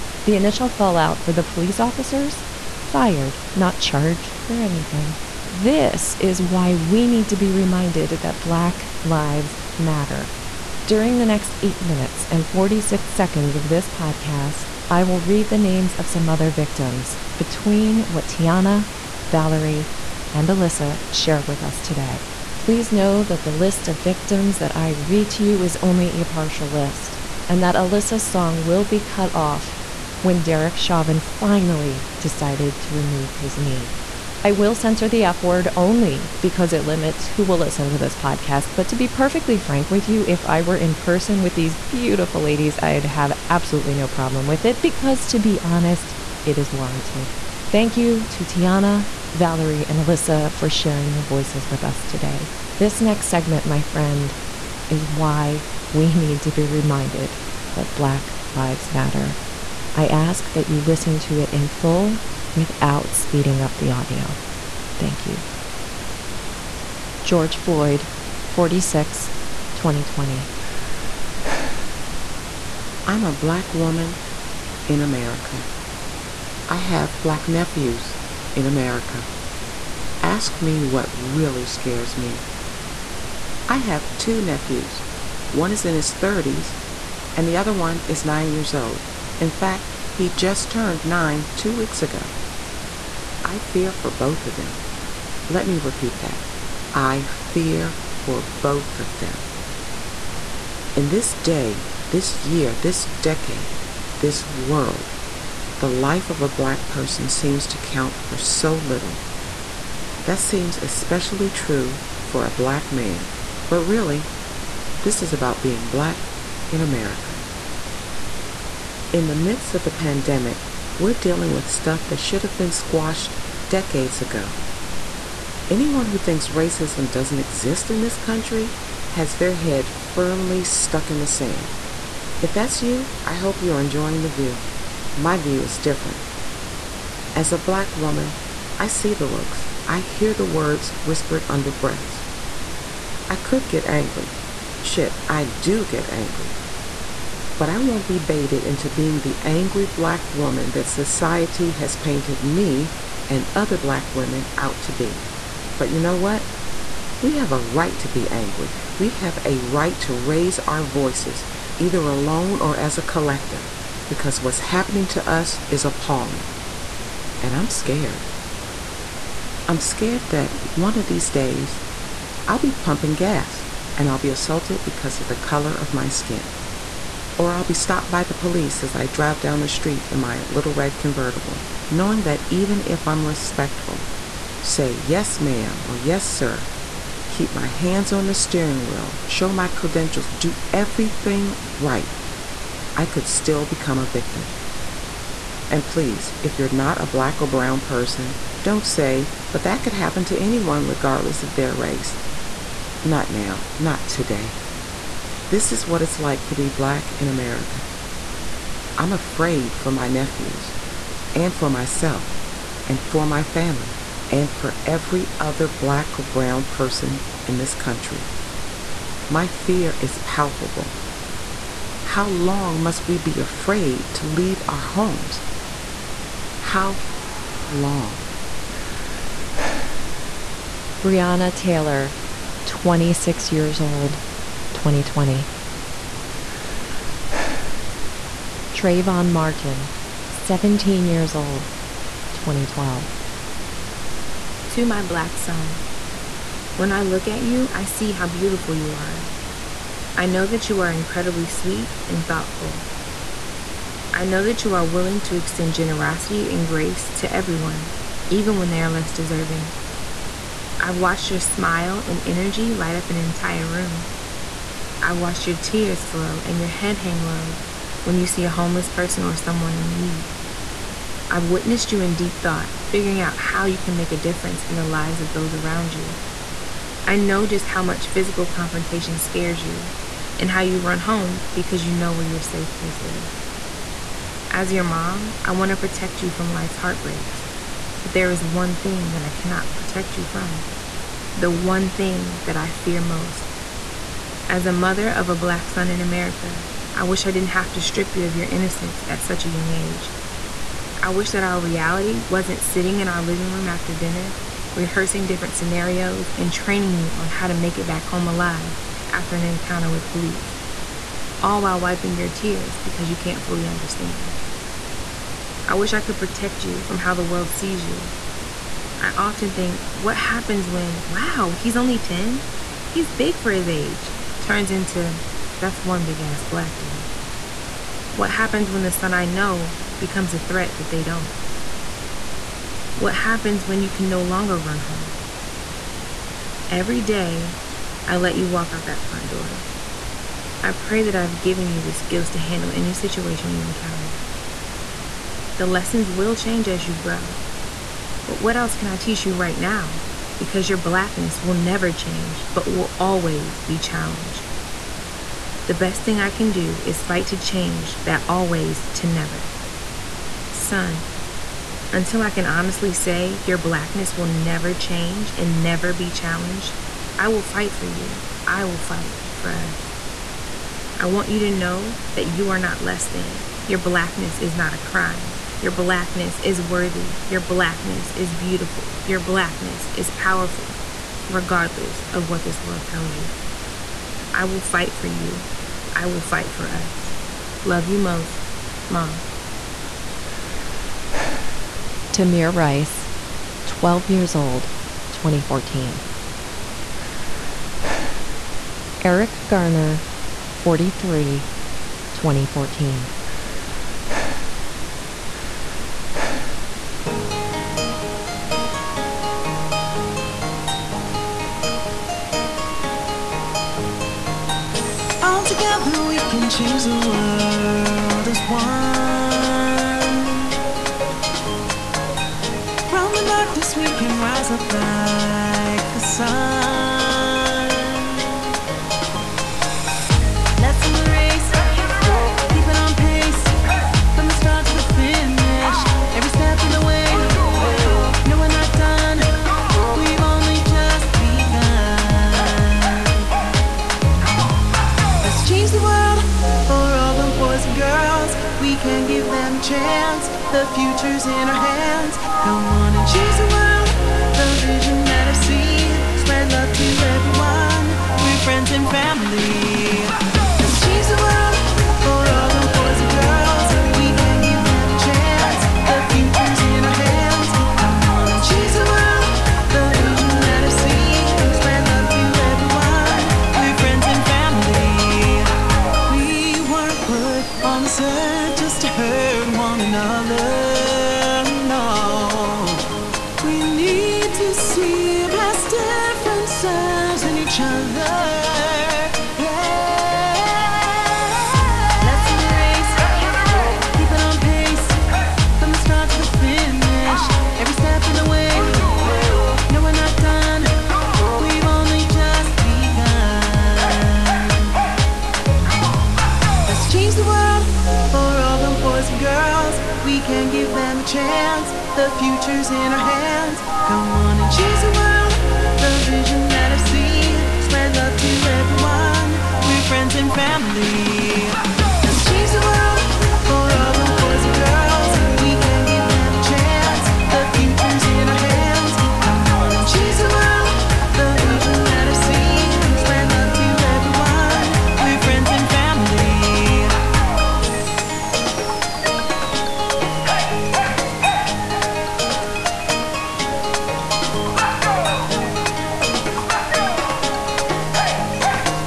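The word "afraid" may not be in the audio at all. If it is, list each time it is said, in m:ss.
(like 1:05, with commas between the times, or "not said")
3:29, 3:43.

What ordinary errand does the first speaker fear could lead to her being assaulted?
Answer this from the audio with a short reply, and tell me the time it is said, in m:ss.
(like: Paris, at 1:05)
pumping gas, at 2:52.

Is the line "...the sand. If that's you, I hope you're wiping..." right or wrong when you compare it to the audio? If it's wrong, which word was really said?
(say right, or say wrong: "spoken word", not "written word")
wrong: "enjoying", not "wiping".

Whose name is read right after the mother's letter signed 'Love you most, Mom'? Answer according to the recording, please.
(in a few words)
Tamir Rice.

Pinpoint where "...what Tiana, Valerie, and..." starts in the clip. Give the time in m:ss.
0:18.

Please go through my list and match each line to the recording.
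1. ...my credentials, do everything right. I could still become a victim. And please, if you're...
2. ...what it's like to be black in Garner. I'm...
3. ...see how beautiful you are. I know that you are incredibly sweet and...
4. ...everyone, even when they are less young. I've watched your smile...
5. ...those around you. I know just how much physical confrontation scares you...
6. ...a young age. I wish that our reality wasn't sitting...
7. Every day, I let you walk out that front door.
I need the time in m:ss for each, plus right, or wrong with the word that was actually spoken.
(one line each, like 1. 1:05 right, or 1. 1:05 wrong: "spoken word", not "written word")
1. 3:09 right
2. 3:25 wrong: "America", not "Garner"
3. 4:07 right
4. 4:17 wrong: "deserving", not "young"
5. 4:35 right
6. 4:59 right
7. 5:36 right.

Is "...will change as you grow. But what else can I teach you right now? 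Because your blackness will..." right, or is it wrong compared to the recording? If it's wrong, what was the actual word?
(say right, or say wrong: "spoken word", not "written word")
right.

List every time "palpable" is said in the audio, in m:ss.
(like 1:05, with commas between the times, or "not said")
3:40.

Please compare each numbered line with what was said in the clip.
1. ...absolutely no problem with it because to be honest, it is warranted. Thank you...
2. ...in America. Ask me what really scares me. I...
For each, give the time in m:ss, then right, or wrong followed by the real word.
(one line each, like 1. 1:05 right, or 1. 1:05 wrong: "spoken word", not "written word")
1. 0:43 right
2. 1:18 right.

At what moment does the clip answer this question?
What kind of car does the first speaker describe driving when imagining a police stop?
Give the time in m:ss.
3:00.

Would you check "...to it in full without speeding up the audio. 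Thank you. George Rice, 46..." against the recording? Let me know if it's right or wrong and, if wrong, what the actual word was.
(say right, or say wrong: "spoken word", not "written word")
wrong: "Floyd", not "Rice".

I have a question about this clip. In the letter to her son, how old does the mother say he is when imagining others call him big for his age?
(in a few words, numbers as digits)
10.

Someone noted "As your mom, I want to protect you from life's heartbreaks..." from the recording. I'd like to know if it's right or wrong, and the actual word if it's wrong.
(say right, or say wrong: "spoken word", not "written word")
right.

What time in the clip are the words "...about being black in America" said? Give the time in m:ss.
1:55.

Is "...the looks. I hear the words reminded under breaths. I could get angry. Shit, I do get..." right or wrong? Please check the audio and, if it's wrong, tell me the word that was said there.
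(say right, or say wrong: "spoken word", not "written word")
wrong: "whispered", not "reminded".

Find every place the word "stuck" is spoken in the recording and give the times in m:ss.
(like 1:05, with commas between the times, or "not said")
2:10.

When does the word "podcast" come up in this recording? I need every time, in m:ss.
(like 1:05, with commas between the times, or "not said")
0:13, 0:38.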